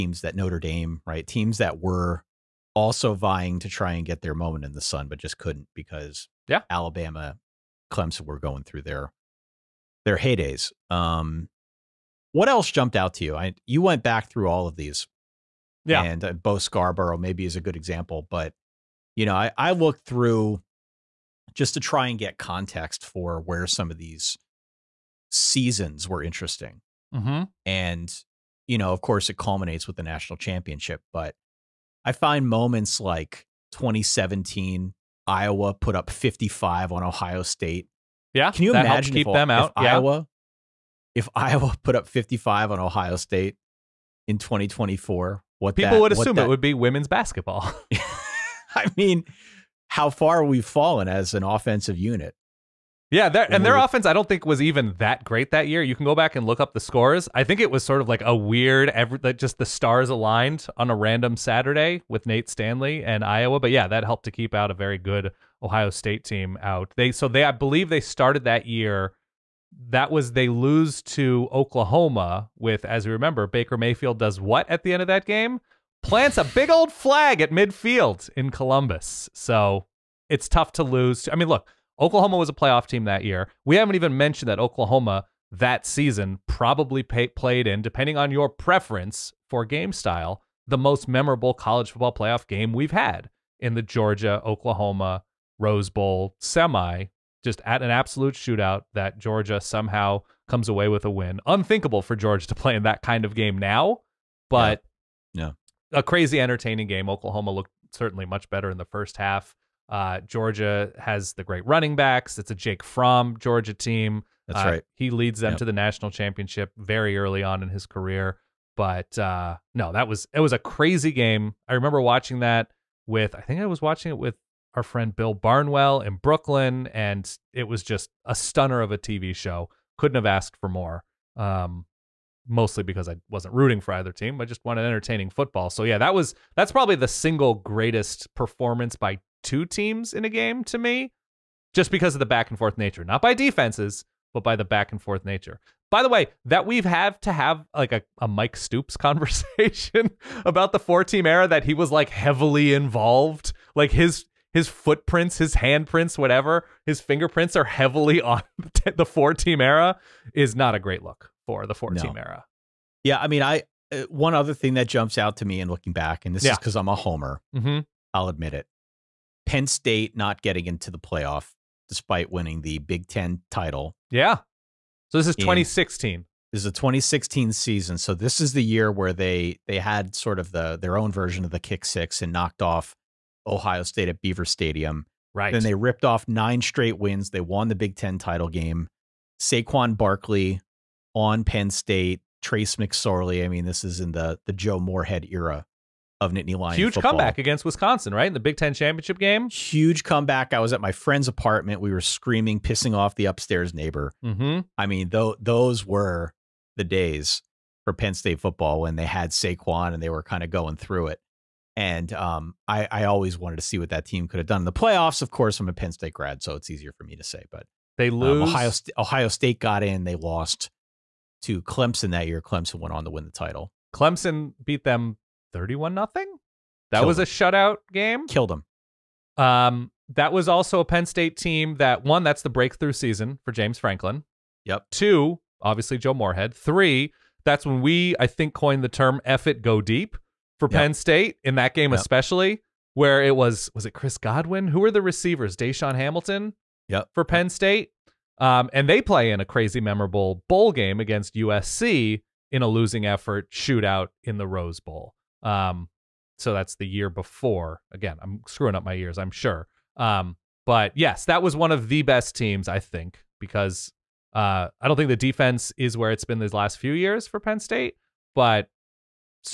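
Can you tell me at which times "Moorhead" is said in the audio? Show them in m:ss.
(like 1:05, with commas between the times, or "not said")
3:14, 3:56.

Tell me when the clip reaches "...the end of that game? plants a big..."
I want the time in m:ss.
1:14.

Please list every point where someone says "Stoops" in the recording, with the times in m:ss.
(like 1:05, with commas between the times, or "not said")
2:28.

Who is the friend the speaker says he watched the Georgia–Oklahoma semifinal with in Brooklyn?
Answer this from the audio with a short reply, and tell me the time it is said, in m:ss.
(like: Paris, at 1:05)
Bill Barnwell, at 2:05.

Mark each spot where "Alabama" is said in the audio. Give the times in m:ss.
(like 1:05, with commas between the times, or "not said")
0:06.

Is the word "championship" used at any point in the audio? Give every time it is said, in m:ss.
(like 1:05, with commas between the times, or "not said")
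0:30, 1:56, 3:18.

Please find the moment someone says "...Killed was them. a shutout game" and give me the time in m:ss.
3:46.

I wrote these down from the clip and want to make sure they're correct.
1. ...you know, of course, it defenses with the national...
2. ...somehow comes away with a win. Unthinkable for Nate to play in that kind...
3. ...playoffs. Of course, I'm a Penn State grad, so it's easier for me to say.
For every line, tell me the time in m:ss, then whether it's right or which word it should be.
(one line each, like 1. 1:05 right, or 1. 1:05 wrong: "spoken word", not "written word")
1. 0:28 wrong: "culminates", not "defenses"
2. 1:39 wrong: "Georgia", not "Nate"
3. 3:34 right.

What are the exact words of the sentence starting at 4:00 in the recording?
Penn State in that game, yep.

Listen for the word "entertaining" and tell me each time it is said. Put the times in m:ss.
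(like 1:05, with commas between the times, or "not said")
1:46, 2:14.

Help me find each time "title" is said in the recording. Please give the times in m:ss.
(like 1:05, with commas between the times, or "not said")
2:53, 3:08, 3:43.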